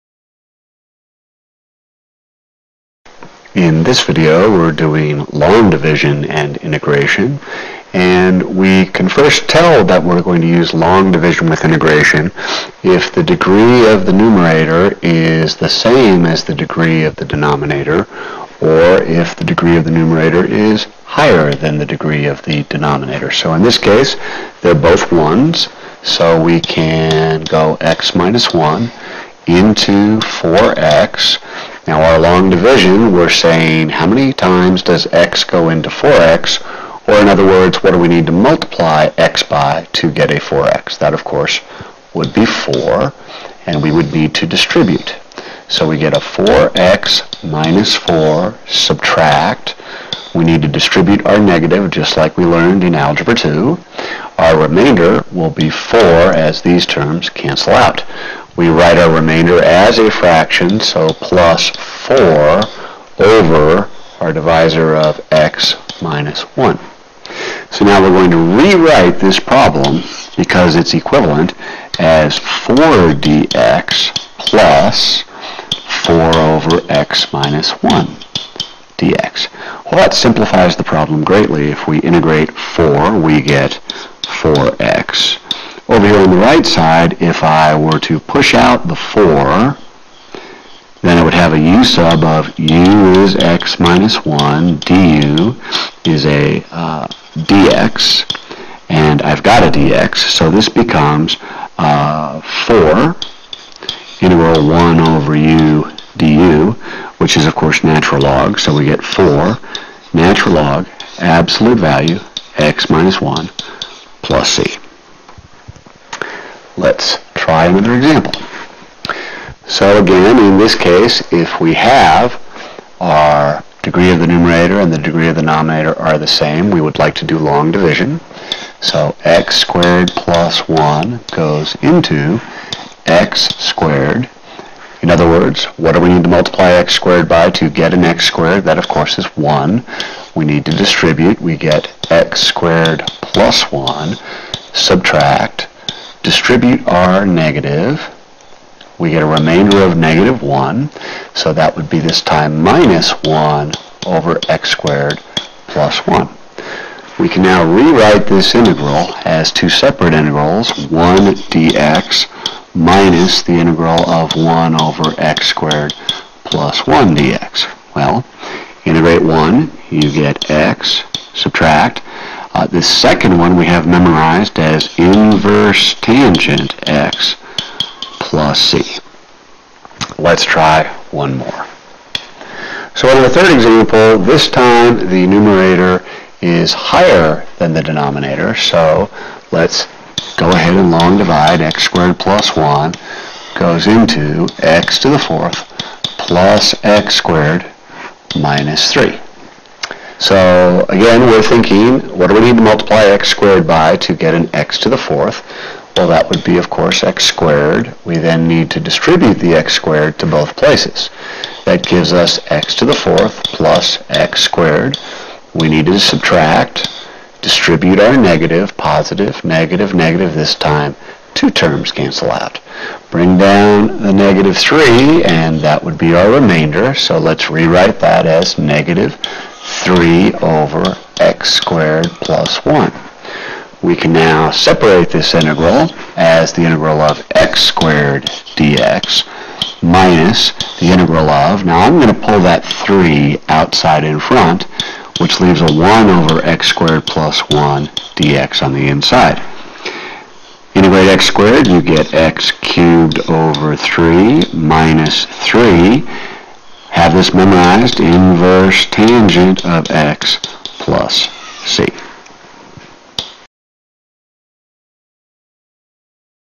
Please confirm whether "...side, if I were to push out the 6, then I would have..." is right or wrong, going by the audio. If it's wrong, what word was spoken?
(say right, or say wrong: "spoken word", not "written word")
wrong: "4", not "6".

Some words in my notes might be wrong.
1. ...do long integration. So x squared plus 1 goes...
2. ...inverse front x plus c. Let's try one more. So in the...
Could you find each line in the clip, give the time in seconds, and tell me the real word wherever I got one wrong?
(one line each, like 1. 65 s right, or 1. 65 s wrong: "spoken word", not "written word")
1. 127 s wrong: "division", not "integration"
2. 174 s wrong: "tangent", not "front".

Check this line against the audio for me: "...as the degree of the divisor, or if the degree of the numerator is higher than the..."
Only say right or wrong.
wrong.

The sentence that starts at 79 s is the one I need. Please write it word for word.
Well, that simplifies the problem greatly.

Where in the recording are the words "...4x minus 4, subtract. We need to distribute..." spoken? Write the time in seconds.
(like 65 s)
46 s.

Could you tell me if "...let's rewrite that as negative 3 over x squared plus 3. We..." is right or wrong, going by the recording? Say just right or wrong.
wrong.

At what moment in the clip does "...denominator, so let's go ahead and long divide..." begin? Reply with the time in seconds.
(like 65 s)
187 s.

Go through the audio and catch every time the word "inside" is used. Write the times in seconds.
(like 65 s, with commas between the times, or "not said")
248 s.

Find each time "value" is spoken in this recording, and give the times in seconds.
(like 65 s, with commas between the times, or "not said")
111 s.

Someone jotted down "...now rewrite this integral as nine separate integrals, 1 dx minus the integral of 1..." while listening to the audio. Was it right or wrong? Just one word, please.
wrong.